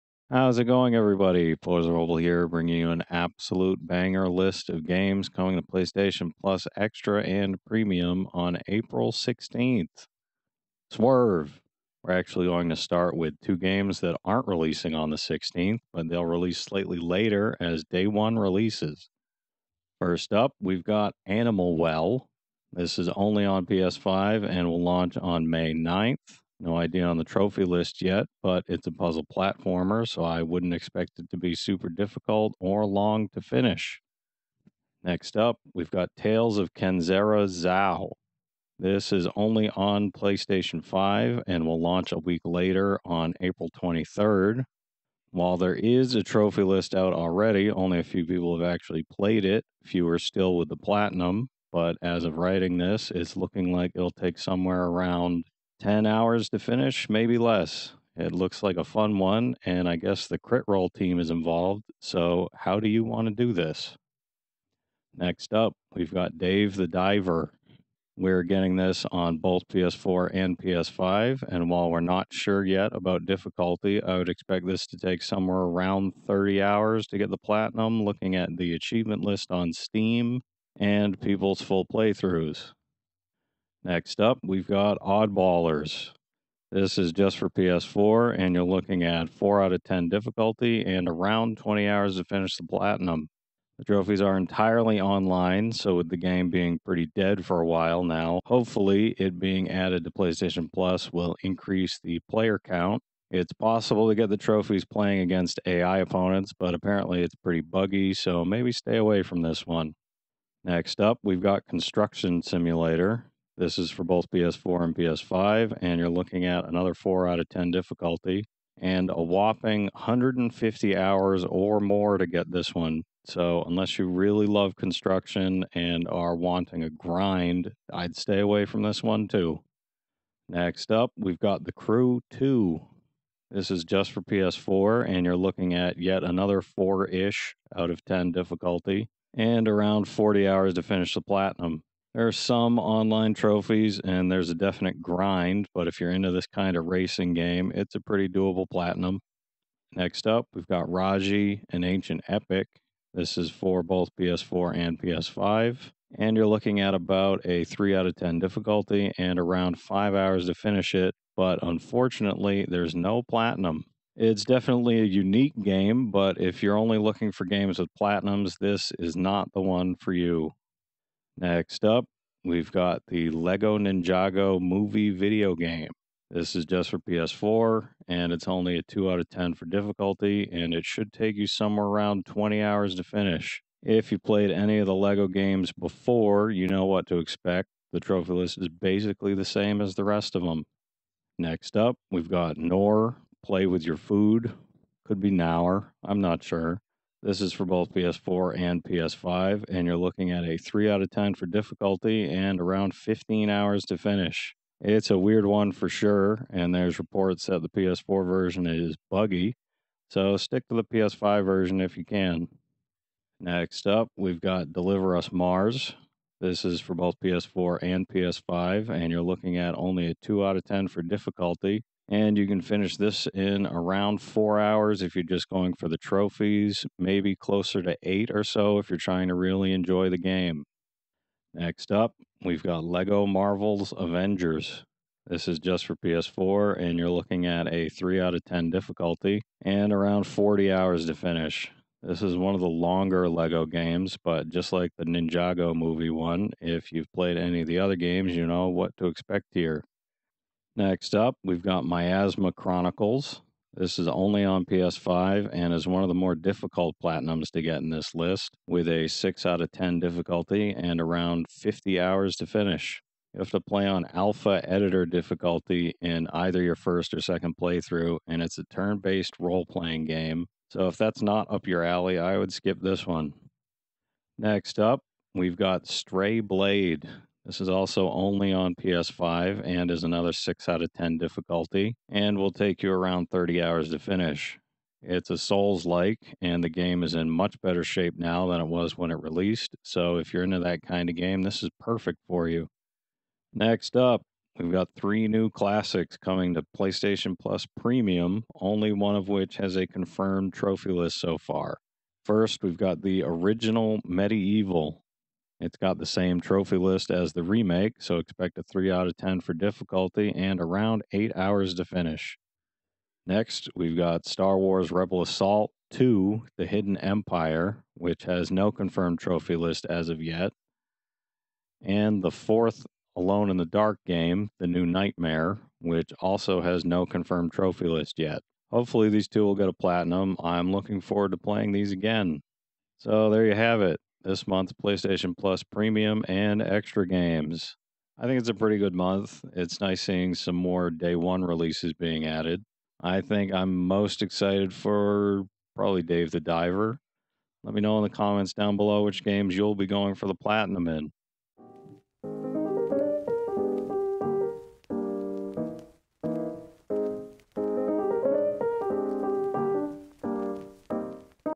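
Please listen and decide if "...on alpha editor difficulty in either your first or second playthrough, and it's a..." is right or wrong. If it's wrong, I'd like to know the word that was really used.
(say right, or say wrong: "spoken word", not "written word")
right.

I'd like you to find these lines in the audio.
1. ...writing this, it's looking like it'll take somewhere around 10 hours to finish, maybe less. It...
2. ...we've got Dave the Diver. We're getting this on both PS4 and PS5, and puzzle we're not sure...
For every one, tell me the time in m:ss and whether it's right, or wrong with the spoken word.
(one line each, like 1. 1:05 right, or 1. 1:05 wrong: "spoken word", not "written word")
1. 0:52 right
2. 1:05 wrong: "while", not "puzzle".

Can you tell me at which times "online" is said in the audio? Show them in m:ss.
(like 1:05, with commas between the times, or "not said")
1:35, 2:22.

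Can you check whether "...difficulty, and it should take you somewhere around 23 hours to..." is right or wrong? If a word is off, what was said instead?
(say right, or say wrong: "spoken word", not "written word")
wrong: "20", not "23".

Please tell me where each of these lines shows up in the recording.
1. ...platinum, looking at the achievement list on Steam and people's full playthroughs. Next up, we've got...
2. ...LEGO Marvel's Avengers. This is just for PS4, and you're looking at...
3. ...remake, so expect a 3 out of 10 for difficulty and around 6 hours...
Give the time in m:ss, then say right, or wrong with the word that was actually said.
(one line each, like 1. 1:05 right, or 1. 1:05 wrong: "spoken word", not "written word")
1. 1:17 right
2. 3:52 right
3. 5:07 wrong: "8", not "6".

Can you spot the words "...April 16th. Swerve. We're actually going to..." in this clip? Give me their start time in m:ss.
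0:08.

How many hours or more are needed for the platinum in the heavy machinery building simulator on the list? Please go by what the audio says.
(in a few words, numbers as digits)
150.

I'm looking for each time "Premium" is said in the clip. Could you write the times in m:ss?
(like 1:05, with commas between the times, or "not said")
0:07, 4:57, 5:35.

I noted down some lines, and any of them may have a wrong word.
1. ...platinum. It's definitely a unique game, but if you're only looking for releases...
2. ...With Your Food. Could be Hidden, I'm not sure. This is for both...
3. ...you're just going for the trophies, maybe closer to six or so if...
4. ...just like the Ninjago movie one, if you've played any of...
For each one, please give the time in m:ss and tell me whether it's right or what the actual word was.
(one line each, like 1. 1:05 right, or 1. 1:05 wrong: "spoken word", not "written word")
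1. 2:43 wrong: "games", not "releases"
2. 3:13 wrong: "Nour", not "Hidden"
3. 3:45 wrong: "eight", not "six"
4. 4:04 right.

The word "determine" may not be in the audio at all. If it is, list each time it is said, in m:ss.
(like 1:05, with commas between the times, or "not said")
not said.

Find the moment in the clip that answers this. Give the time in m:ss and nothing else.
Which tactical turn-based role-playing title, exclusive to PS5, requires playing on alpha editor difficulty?
4:11.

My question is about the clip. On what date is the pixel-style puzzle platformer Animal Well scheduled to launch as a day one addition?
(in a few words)
May 9th.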